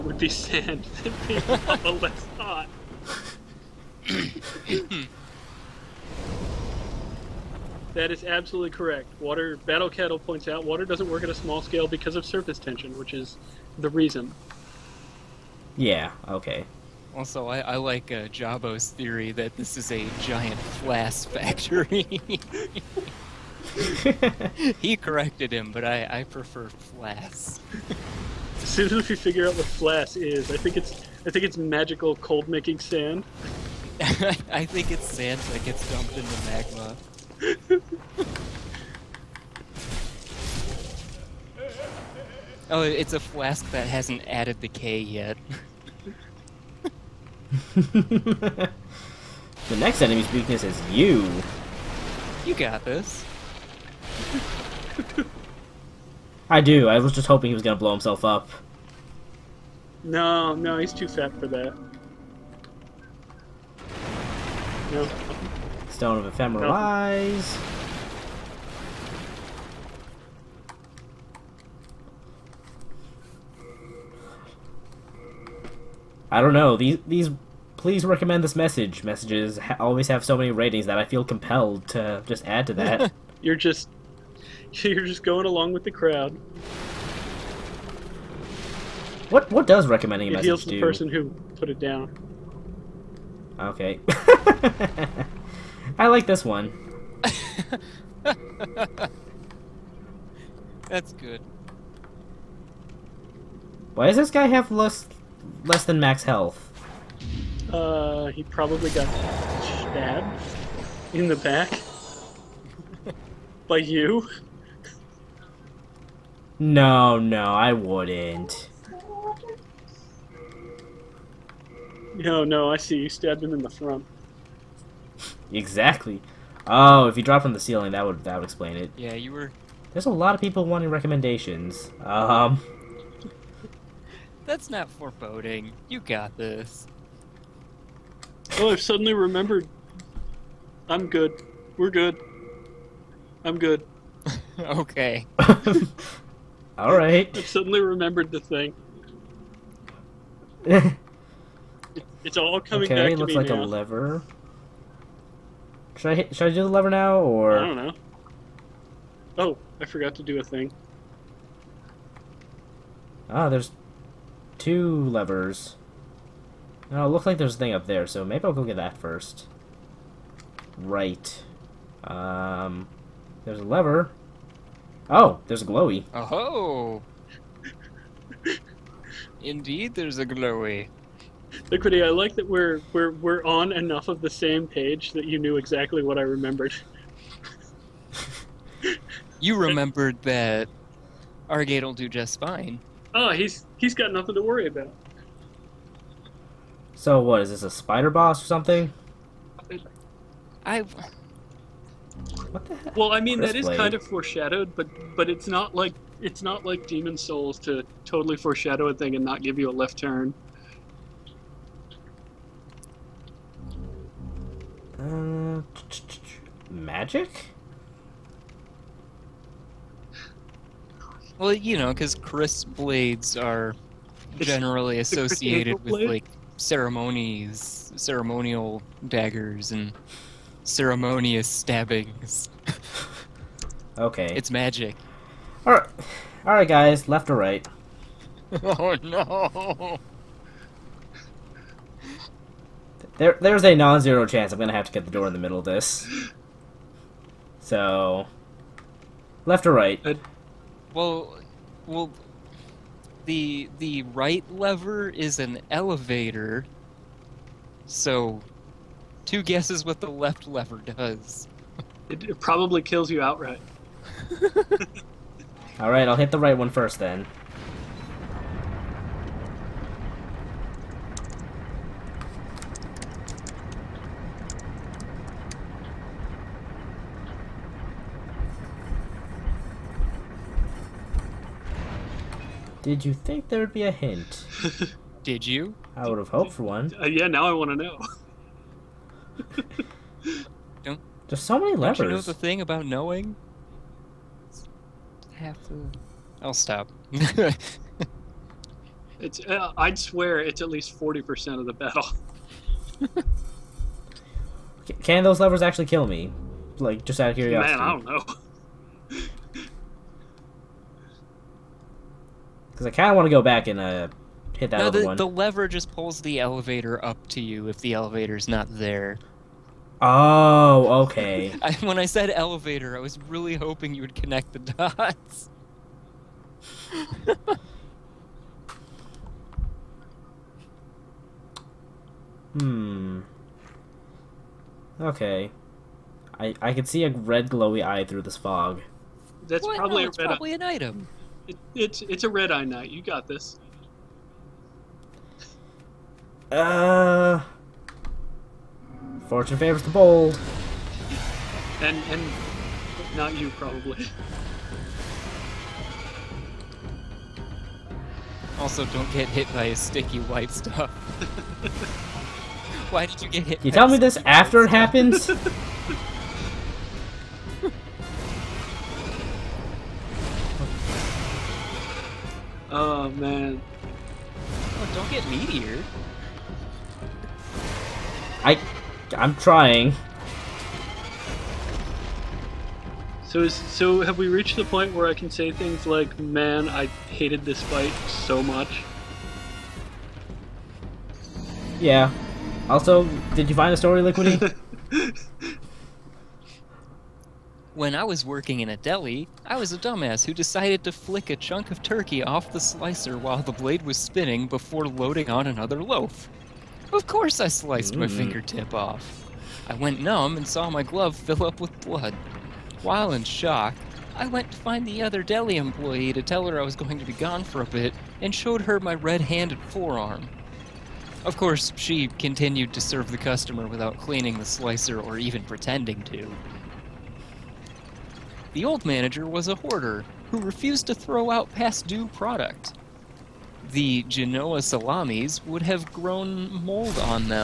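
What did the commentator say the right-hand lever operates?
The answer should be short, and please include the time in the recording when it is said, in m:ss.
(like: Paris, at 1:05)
An elevator, at 4:15.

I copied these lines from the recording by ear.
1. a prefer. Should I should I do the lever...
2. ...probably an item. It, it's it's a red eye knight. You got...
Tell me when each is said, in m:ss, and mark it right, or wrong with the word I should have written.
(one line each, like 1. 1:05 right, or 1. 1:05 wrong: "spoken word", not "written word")
1. 2:33 wrong: "lever", not "prefer"
2. 5:40 right.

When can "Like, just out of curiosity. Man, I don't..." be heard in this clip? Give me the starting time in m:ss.
5:06.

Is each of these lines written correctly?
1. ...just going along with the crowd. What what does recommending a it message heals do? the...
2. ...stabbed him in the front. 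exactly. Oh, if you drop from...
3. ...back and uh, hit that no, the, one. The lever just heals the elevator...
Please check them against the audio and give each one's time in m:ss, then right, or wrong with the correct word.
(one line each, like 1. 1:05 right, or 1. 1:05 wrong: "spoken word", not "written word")
1. 1:25 right
2. 2:03 right
3. 5:13 wrong: "pulls", not "heals".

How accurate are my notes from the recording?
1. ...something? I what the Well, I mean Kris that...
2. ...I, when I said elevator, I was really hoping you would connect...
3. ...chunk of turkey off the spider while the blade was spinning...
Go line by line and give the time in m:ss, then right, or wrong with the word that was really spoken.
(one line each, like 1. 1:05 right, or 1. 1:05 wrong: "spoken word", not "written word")
1. 3:18 right
2. 5:21 right
3. 6:41 wrong: "slicer", not "spider".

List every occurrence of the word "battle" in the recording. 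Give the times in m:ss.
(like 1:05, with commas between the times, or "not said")
0:09, 5:01.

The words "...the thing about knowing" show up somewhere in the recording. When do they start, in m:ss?
4:52.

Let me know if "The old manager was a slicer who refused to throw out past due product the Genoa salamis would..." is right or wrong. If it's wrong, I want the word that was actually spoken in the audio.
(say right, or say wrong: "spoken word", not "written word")
wrong: "hoarder", not "slicer".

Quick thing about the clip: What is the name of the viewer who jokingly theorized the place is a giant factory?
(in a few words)
Jabo.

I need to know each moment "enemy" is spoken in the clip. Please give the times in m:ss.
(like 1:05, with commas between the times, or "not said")
0:50.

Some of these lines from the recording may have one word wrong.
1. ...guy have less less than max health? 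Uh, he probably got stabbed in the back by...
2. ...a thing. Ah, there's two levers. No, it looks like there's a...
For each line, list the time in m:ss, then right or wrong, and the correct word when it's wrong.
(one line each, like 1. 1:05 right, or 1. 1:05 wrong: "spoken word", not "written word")
1. 1:44 right
2. 2:40 right.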